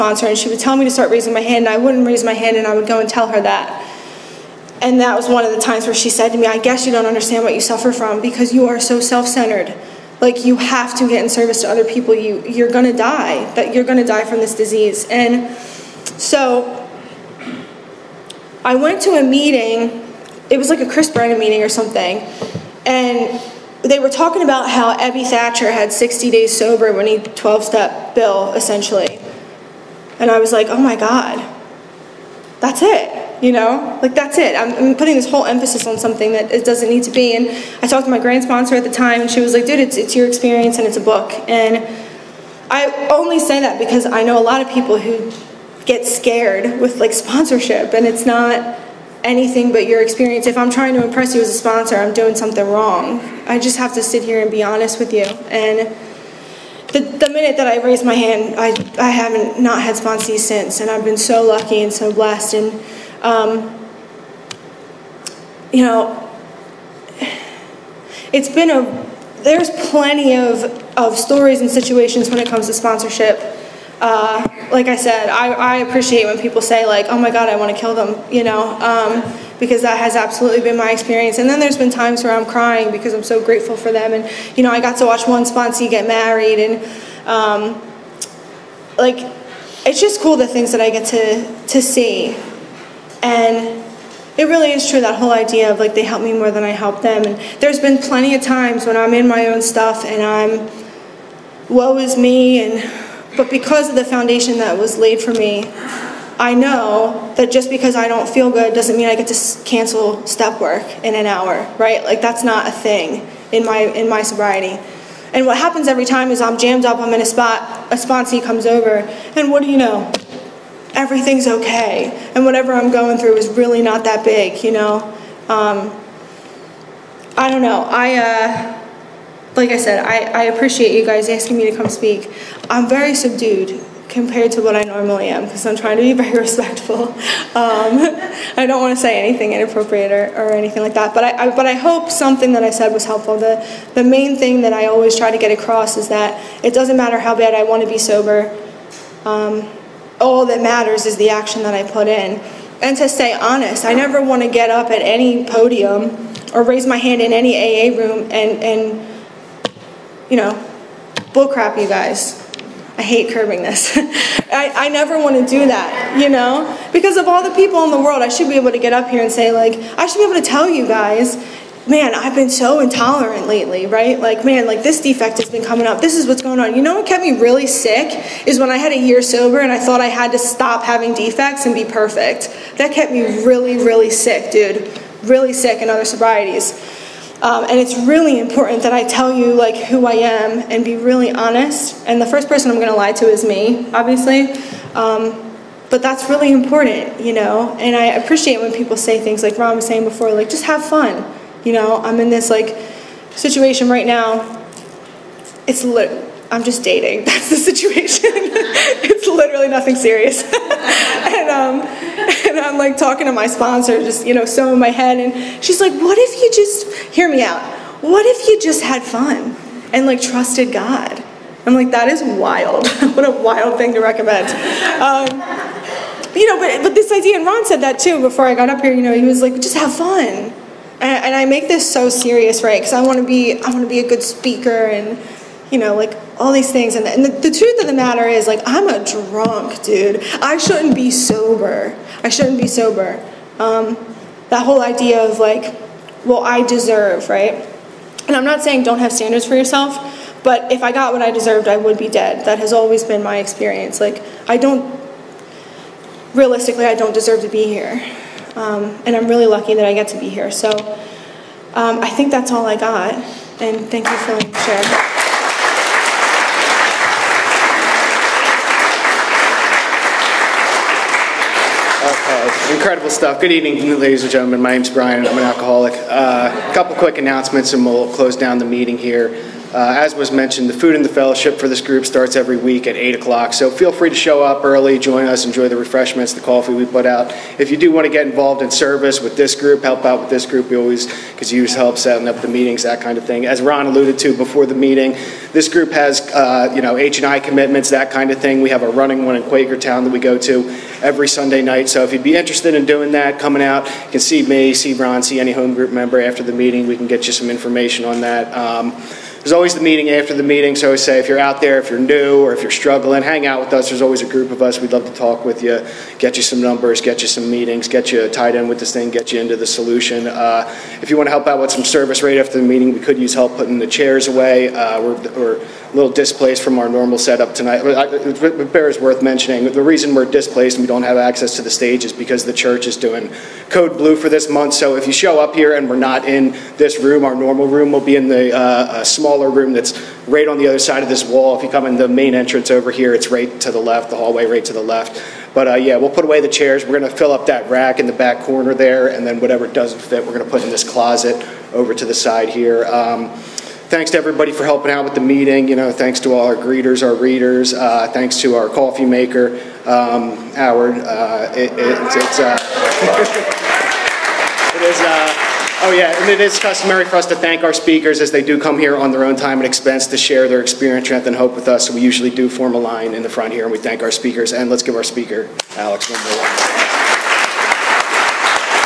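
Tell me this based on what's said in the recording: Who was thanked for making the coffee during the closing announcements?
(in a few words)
Howard.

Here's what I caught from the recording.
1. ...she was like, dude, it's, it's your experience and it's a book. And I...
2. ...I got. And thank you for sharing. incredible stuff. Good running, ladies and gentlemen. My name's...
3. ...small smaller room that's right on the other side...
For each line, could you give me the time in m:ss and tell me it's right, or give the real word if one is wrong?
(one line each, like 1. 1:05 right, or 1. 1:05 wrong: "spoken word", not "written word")
1. 0:39 right
2. 4:22 wrong: "evening", not "running"
3. 5:39 right.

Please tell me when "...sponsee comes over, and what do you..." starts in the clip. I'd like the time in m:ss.
1:57.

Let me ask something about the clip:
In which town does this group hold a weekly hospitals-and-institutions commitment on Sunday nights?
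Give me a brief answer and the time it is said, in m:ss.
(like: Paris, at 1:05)
Quakertown, at 4:59.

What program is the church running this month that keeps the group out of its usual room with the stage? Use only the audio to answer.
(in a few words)
Code Blue.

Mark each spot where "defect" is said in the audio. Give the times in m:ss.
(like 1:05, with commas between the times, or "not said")
2:55, 3:01.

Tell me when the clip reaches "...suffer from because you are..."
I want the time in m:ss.
0:07.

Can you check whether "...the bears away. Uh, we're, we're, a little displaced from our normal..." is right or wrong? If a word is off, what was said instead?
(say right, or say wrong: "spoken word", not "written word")
wrong: "chairs", not "bears".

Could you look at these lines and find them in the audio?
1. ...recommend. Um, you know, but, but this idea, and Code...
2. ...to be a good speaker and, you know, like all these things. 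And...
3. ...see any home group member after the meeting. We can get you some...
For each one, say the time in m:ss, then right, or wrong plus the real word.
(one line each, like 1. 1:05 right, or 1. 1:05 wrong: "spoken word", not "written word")
1. 3:44 wrong: "Ron", not "Code"
2. 3:53 right
3. 5:05 right.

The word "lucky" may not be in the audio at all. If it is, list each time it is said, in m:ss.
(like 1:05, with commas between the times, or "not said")
1:01, 4:19.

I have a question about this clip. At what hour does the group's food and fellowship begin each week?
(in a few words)
8 o'clock.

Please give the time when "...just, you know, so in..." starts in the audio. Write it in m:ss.
3:33.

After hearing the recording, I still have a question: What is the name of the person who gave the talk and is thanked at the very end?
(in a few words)
Alex.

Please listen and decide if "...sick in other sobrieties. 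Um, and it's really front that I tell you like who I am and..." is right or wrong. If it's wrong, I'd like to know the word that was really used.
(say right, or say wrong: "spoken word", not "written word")
wrong: "important", not "front".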